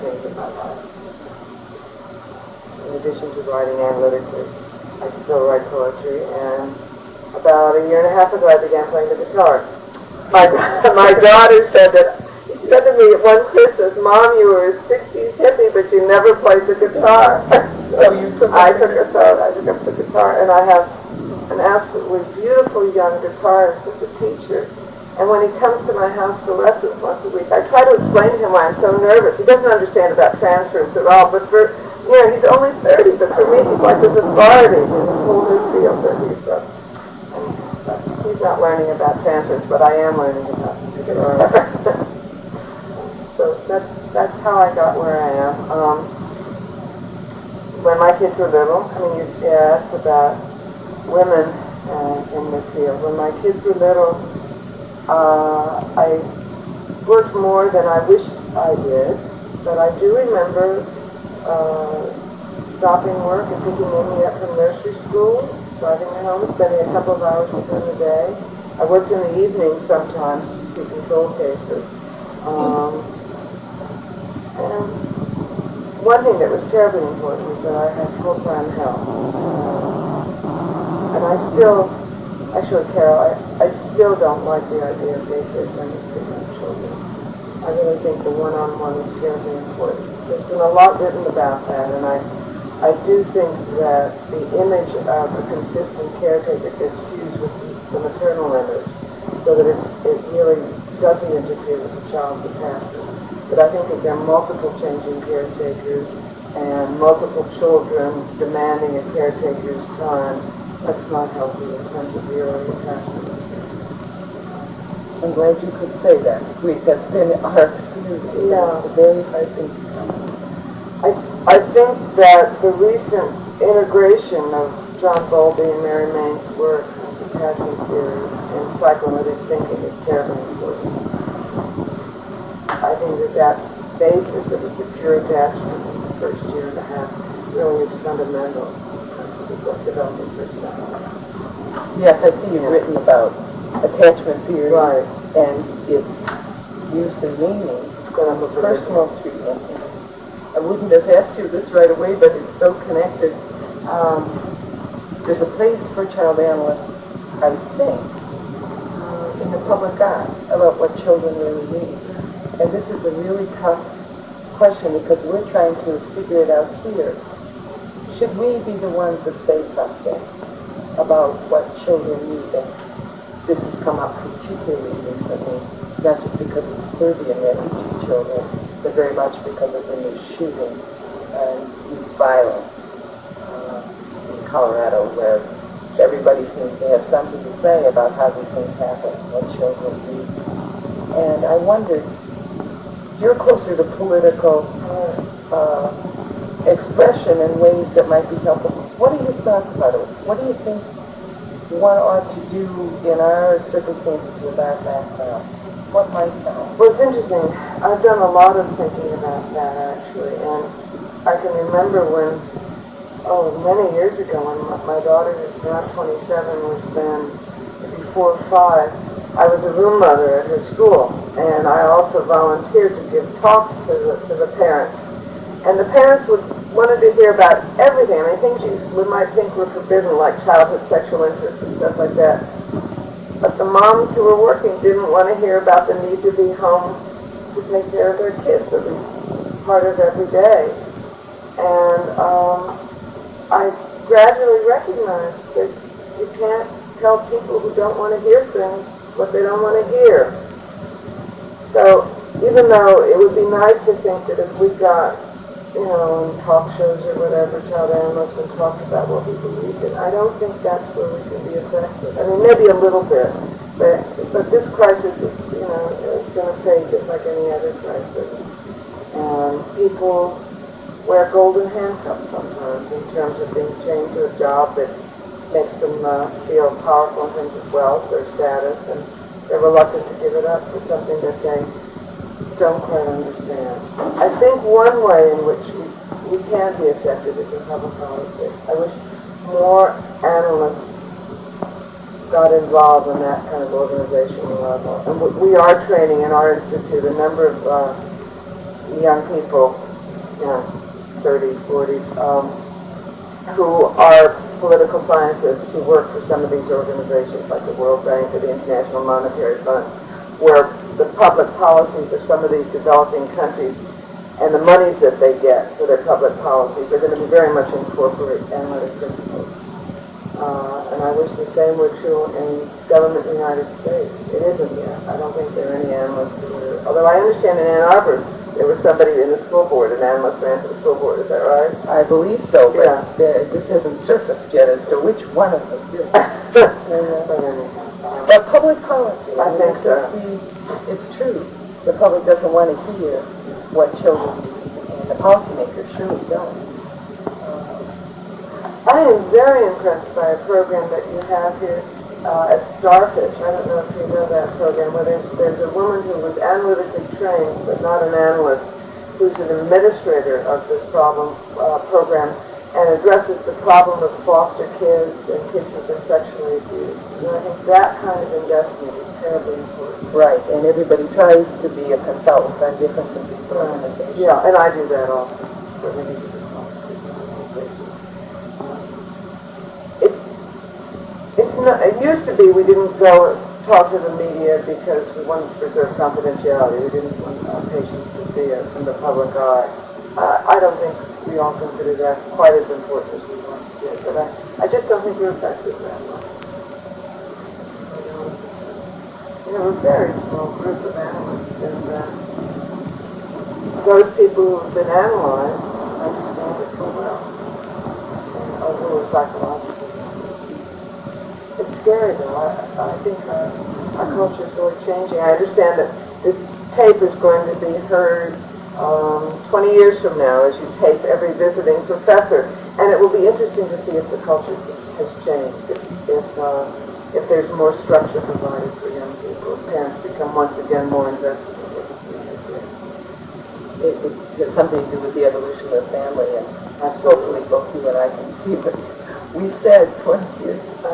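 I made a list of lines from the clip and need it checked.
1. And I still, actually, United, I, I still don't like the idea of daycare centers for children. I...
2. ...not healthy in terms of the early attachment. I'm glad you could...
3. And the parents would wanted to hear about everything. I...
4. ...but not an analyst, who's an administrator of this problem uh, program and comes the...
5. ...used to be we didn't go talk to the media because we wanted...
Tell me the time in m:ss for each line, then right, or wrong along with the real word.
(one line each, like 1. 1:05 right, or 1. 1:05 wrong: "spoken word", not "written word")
1. 1:21 wrong: "Carol", not "United"
2. 1:51 right
3. 3:45 right
4. 5:57 wrong: "addresses", not "comes"
5. 6:22 right.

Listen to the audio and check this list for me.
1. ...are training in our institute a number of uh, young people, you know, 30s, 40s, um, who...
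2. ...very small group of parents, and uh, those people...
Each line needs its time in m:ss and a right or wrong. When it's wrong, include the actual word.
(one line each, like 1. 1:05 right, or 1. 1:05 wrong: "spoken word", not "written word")
1. 4:55 right
2. 6:39 wrong: "analysts", not "parents".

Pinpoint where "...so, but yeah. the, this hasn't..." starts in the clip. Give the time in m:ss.
5:32.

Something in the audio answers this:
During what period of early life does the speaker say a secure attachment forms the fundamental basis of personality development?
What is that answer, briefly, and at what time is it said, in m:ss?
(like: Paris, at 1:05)
first year and a half, at 2:16.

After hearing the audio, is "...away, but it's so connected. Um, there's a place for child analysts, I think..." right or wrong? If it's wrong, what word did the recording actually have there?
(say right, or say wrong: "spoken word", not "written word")
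right.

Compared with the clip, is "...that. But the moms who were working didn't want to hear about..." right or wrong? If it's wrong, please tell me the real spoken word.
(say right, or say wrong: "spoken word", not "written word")
right.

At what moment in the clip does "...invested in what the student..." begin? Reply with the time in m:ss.
7:11.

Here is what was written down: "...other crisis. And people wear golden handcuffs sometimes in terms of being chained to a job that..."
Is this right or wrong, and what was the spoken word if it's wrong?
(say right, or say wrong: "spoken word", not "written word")
right.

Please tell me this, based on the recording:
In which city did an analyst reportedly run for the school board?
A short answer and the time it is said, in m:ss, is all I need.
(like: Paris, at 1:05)
Ann Arbor, at 5:27.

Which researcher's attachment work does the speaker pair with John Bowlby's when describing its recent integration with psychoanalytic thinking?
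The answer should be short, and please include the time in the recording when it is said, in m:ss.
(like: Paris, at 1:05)
Mary Main, at 2:05.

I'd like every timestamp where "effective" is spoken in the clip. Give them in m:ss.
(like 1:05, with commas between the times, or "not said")
4:21, 4:46.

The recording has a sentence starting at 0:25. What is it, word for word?
And when he comes to my house for lessons once a week, I try to explain to him why I'm so nervous.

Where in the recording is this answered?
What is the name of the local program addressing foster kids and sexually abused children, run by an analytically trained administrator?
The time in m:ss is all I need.
5:52.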